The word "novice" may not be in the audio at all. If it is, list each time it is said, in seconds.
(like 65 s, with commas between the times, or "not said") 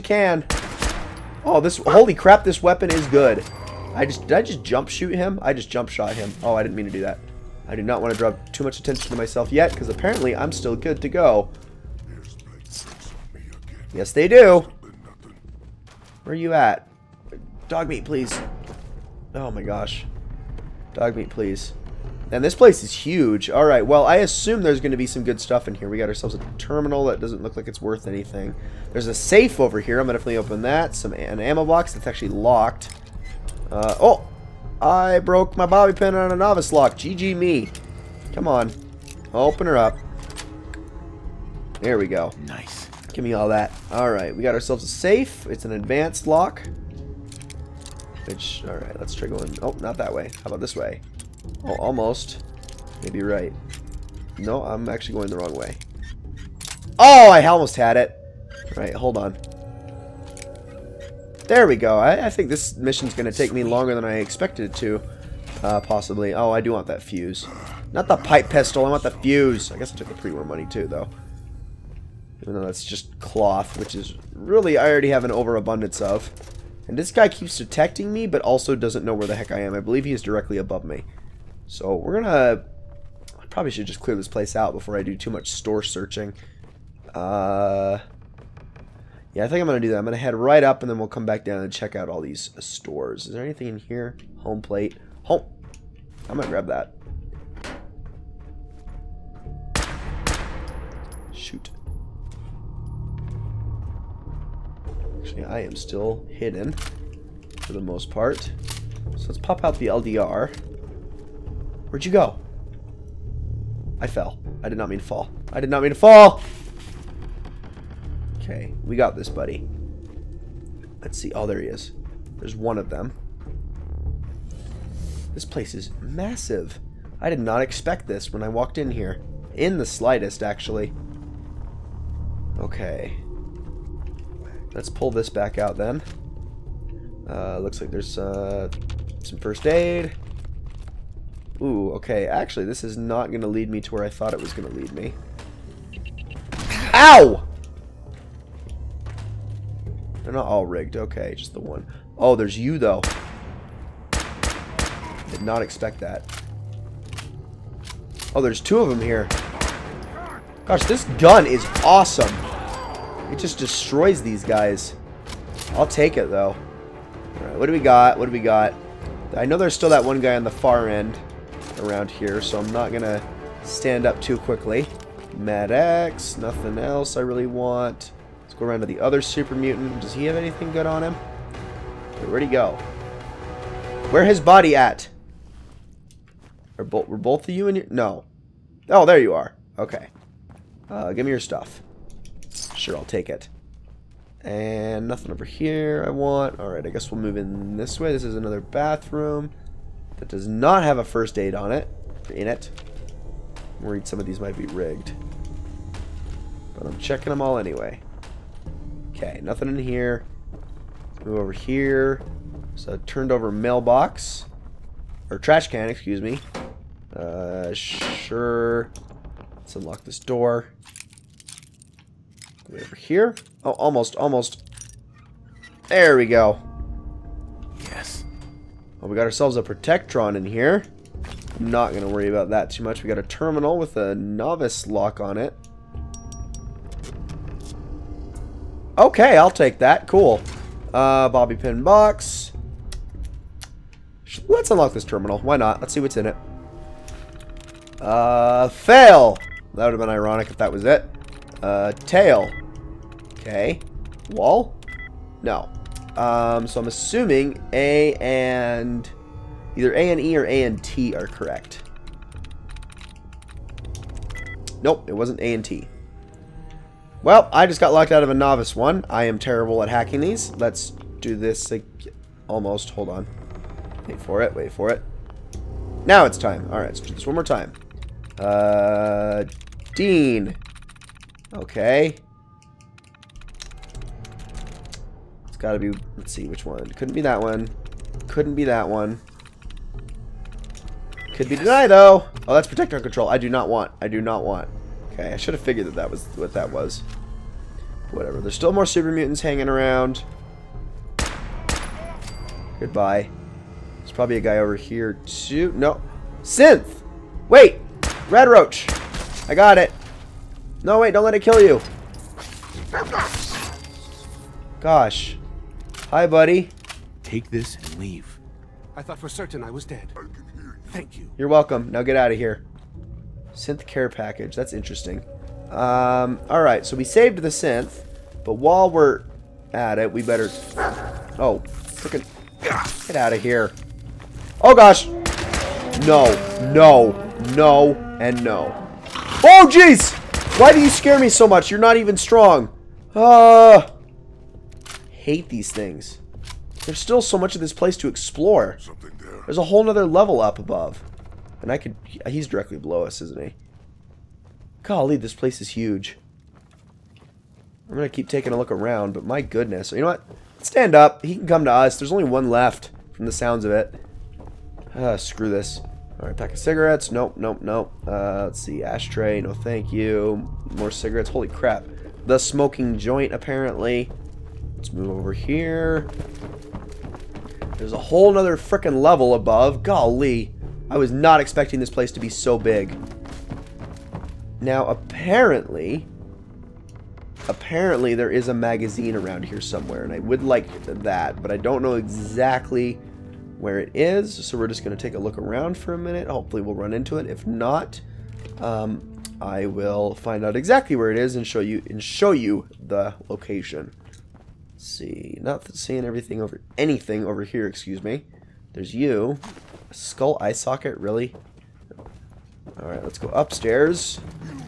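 36 s, 234 s, 268 s.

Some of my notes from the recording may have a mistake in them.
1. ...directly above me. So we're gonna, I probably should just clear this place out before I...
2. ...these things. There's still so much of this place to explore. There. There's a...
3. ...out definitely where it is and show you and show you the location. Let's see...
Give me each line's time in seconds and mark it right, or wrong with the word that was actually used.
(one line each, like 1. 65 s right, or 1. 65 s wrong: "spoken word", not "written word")
1. 80 s right
2. 345 s right
3. 400 s wrong: "exactly", not "definitely".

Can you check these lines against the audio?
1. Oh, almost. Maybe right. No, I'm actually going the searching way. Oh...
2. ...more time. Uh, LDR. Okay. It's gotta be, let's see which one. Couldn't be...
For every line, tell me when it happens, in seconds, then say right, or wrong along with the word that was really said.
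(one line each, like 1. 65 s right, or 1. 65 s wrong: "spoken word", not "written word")
1. 51 s wrong: "wrong", not "searching"
2. 277 s wrong: "Dean", not "LDR".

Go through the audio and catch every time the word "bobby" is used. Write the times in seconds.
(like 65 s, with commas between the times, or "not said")
35 s, 241 s.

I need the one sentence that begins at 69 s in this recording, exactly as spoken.
I guess I took the pre-war money too, though.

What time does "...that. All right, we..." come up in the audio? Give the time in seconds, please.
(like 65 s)
43 s.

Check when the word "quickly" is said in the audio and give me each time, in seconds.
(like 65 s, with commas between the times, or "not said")
174 s.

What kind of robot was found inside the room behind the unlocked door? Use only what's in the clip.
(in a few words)
Protectron.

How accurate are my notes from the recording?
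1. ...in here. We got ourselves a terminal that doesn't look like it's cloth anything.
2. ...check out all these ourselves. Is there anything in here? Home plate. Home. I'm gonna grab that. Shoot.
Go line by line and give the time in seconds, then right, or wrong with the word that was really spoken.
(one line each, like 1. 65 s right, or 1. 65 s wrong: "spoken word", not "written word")
1. 25 s wrong: "worth", not "cloth"
2. 91 s wrong: "stores", not "ourselves".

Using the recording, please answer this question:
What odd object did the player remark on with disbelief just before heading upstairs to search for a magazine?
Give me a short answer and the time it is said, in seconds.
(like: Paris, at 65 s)
skull eye socket, at 409 s.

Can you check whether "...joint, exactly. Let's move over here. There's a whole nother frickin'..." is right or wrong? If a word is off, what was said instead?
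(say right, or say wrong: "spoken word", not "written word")
wrong: "apparently", not "exactly".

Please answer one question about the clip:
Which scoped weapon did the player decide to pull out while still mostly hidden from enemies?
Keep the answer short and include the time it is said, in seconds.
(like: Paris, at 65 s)
LDR, at 109 s.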